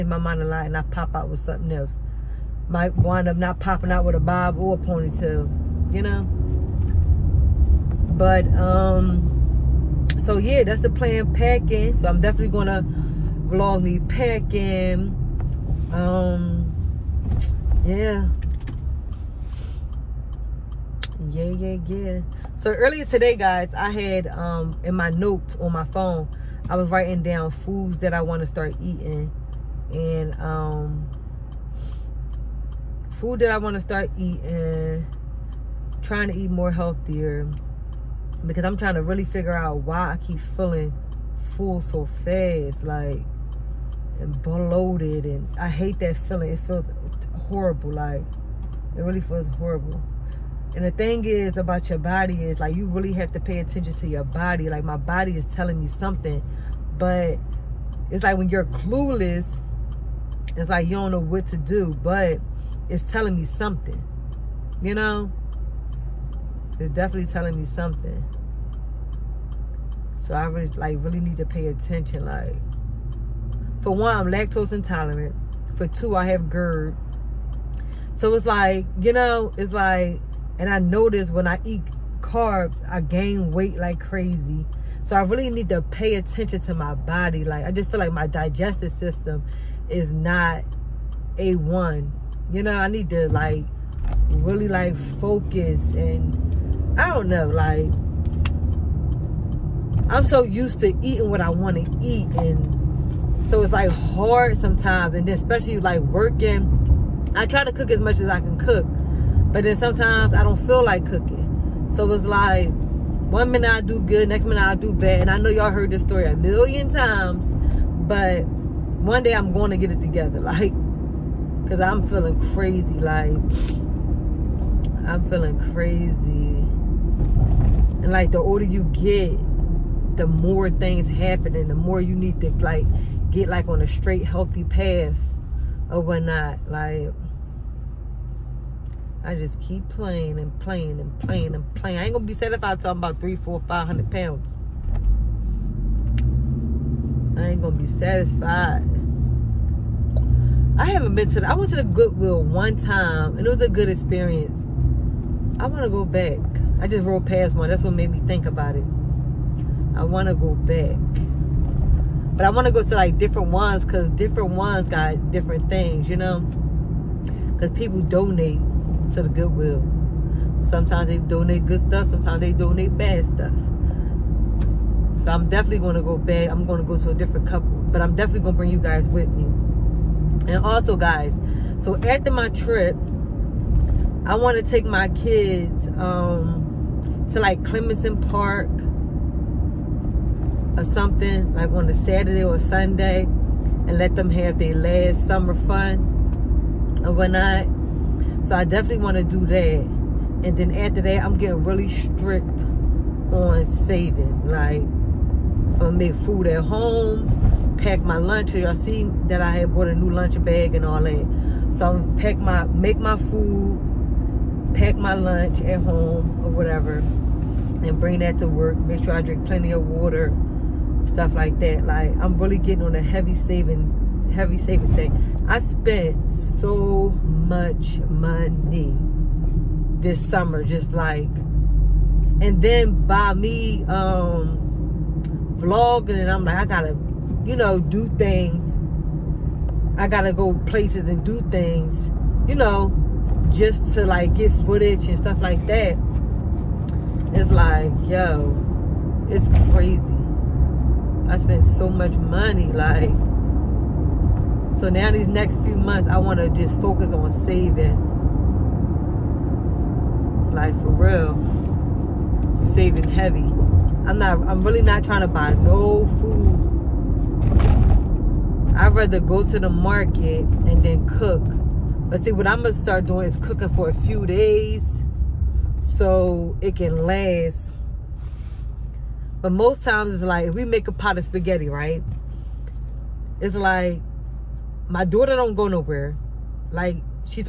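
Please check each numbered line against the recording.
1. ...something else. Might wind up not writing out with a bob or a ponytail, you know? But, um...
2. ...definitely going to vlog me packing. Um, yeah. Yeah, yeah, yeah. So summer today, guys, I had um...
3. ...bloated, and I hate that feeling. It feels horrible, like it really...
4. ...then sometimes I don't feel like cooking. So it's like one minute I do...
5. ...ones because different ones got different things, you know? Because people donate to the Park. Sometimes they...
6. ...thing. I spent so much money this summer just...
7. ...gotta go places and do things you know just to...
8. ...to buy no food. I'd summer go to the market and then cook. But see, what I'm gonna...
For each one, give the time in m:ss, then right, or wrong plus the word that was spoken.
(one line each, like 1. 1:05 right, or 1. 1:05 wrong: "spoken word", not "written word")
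1. 0:01 wrong: "popping", not "writing"
2. 0:12 wrong: "earlier", not "summer"
3. 0:44 right
4. 1:49 right
5. 2:43 wrong: "Goodwill", not "Park"
6. 3:44 right
7. 4:00 right
8. 4:25 wrong: "rather", not "summer".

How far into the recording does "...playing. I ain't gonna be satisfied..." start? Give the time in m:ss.
2:21.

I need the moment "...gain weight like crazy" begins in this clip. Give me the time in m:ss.
1:23.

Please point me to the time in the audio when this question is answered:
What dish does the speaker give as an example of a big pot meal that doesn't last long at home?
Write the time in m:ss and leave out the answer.
4:41.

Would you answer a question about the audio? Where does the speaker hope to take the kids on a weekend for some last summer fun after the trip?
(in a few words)
Clemson Park.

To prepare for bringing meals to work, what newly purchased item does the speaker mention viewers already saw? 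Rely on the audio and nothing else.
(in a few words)
lunch bag.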